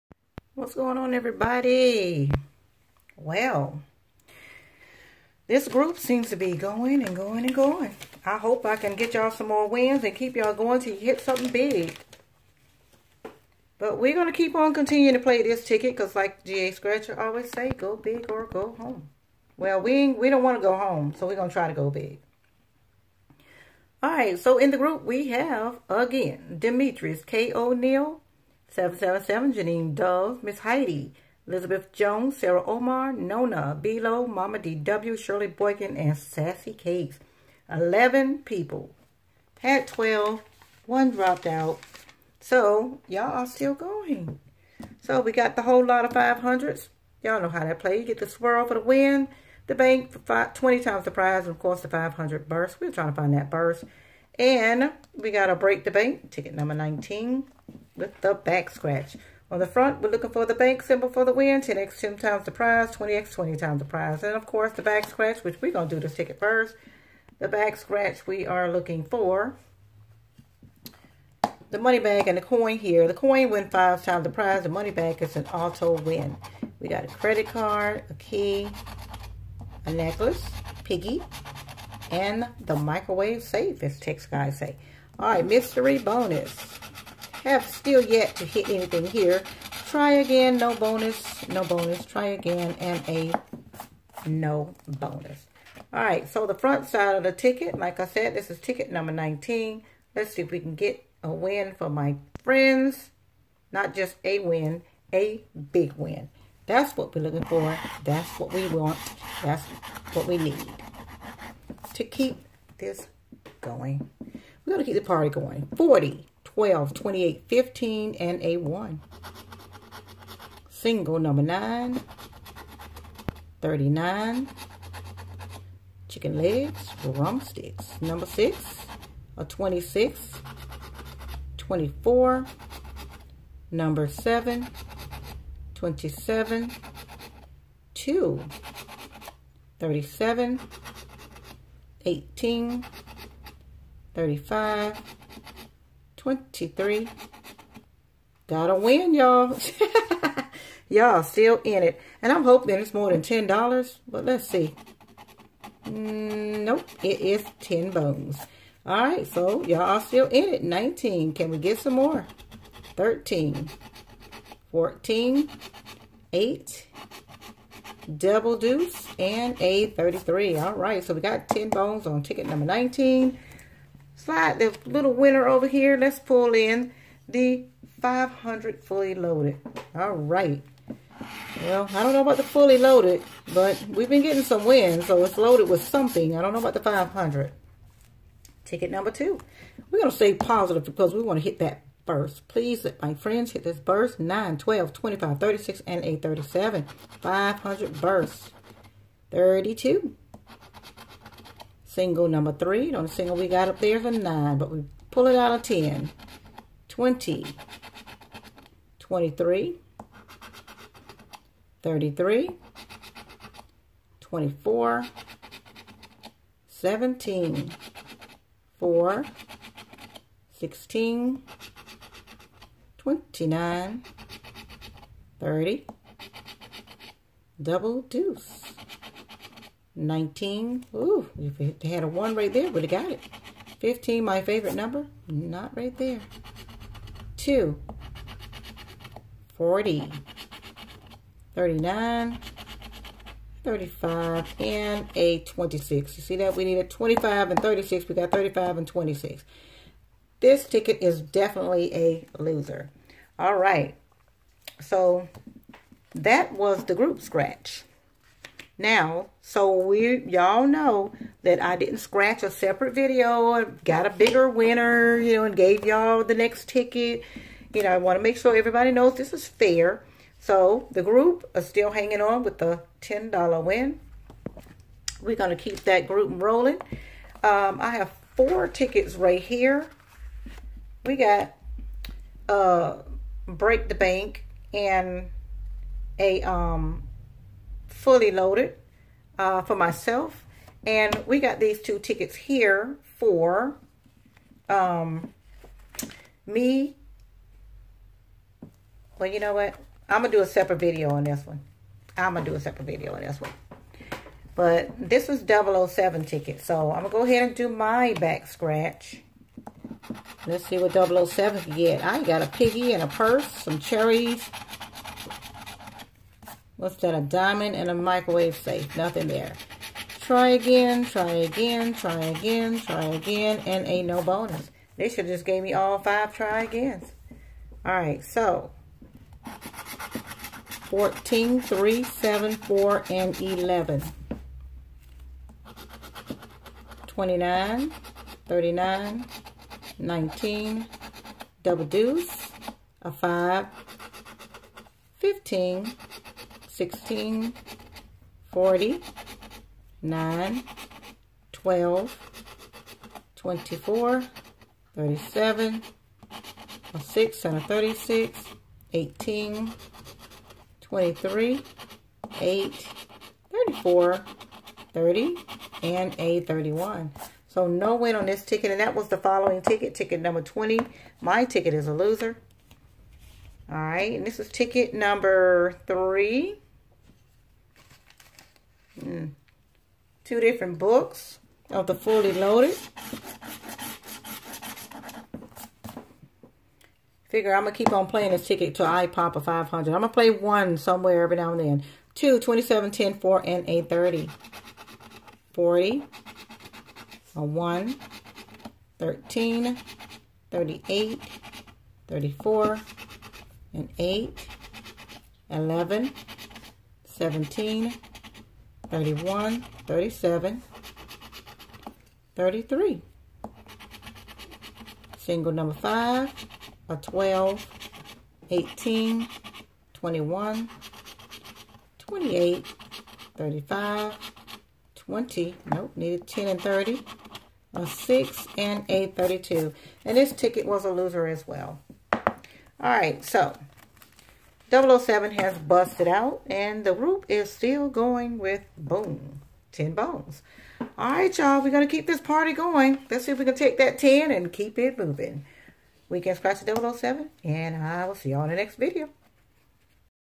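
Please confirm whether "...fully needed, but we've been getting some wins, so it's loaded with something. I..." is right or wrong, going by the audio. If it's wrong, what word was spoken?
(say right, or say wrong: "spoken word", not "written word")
wrong: "loaded", not "needed".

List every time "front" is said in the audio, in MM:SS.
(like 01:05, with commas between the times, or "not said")
00:59, 01:36.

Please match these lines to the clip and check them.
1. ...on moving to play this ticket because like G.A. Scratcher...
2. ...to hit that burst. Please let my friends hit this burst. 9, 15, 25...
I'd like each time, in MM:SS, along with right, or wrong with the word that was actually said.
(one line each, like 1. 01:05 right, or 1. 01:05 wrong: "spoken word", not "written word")
1. 00:14 wrong: "continuing", not "moving"
2. 03:11 wrong: "12", not "15".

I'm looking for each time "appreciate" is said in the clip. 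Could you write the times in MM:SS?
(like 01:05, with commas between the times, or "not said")
not said.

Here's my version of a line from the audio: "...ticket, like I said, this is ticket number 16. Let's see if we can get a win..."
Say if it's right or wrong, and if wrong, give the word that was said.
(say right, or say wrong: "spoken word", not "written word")
wrong: "19", not "16".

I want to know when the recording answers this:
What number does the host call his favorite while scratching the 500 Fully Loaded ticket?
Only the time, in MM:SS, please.
03:53.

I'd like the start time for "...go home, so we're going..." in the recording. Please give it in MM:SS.
00:20.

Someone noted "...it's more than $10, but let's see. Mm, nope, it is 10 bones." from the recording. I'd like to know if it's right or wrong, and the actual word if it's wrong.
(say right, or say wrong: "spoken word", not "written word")
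right.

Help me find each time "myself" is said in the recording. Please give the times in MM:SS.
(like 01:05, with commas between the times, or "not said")
04:49.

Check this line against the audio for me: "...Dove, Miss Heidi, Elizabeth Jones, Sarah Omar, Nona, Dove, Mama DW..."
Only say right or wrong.
wrong.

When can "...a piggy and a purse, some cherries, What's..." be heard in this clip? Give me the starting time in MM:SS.
05:12.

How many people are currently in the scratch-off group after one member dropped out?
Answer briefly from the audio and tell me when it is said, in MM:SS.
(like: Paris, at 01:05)
11, at 00:37.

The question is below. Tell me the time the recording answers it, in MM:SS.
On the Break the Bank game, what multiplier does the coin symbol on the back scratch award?
01:13.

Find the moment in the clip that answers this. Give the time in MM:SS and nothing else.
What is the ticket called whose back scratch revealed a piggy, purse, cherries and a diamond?
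05:05.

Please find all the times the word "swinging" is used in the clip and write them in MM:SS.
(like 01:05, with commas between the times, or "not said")
not said.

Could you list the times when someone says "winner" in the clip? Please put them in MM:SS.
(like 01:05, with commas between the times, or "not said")
02:55, 04:24.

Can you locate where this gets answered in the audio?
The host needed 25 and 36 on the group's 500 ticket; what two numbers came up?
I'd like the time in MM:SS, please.
04:08.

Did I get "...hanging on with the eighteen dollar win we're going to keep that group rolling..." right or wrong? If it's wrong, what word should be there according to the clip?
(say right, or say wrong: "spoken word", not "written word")
wrong: "ten", not "eighteen".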